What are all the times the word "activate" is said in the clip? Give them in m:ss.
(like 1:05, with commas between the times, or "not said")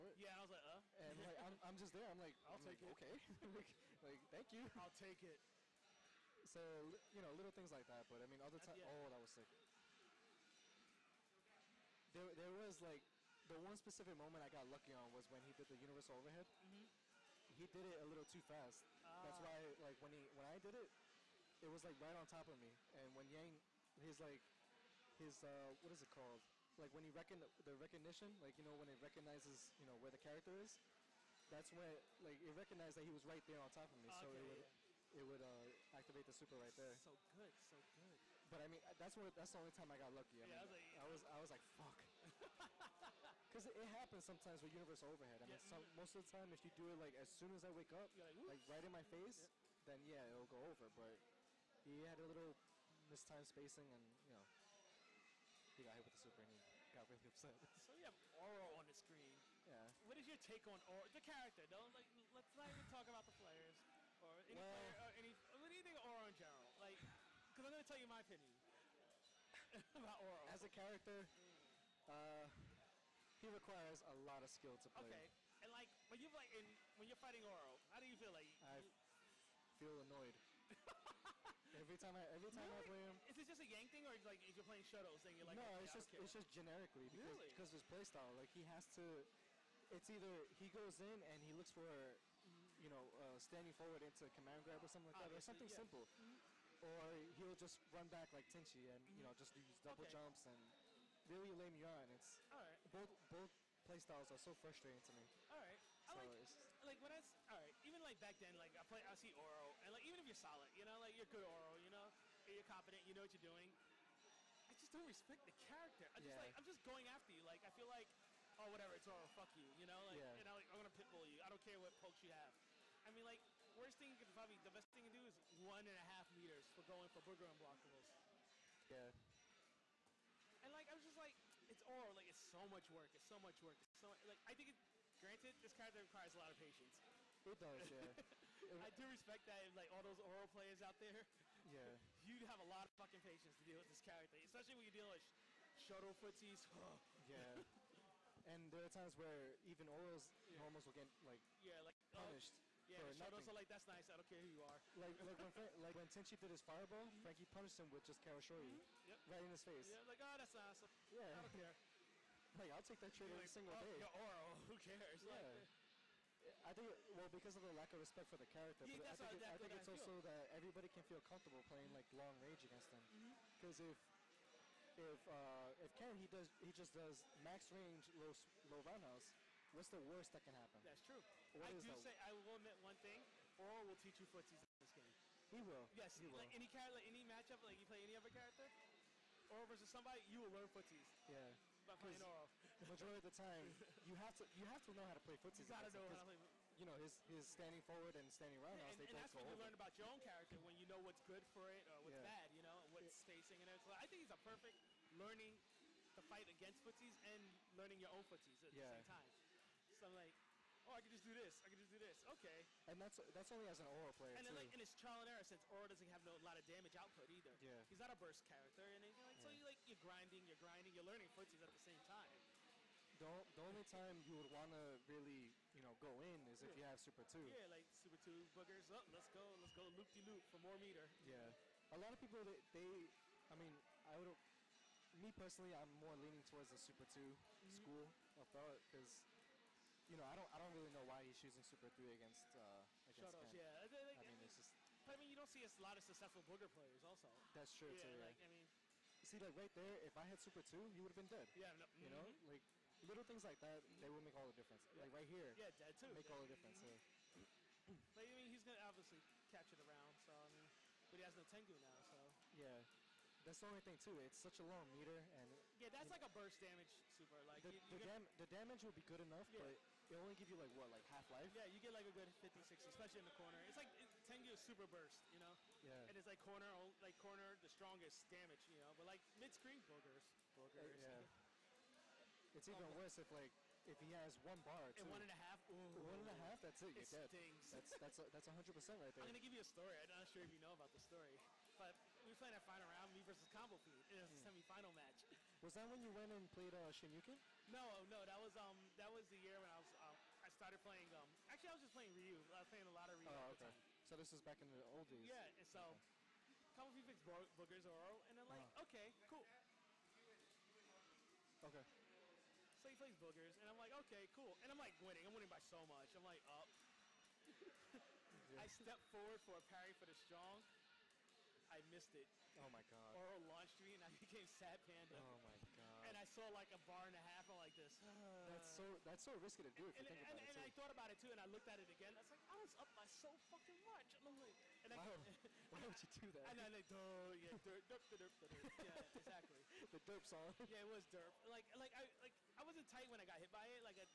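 0:35.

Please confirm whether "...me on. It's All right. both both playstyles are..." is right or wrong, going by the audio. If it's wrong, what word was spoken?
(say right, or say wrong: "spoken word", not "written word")
right.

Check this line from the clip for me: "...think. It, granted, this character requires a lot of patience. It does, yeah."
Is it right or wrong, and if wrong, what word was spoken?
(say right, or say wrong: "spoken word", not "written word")
right.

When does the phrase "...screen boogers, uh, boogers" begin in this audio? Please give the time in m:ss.
4:39.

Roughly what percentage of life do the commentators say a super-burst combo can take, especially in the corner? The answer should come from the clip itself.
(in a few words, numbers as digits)
50, 60.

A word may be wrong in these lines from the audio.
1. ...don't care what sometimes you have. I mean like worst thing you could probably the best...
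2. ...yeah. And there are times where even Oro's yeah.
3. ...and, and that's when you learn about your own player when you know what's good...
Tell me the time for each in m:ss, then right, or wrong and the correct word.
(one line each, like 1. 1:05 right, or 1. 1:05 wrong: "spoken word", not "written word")
1. 2:01 wrong: "pokes", not "sometimes"
2. 2:27 right
3. 3:18 wrong: "character", not "player".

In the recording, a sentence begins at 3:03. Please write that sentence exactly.
Oro will teach you footsies in this game.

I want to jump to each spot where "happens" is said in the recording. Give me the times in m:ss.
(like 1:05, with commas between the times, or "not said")
0:43, 3:00.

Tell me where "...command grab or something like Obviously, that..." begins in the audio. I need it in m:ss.
1:34.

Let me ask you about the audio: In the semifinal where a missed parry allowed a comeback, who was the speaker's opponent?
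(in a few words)
Combo Pete.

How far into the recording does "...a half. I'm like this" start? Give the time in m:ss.
5:27.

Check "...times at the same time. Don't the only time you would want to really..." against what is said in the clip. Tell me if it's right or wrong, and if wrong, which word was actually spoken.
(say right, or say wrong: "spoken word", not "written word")
wrong: "footsies", not "times".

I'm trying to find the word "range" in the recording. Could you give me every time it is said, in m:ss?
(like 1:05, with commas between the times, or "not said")
2:52, 2:57.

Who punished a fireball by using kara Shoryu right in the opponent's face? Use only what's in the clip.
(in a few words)
Frankie.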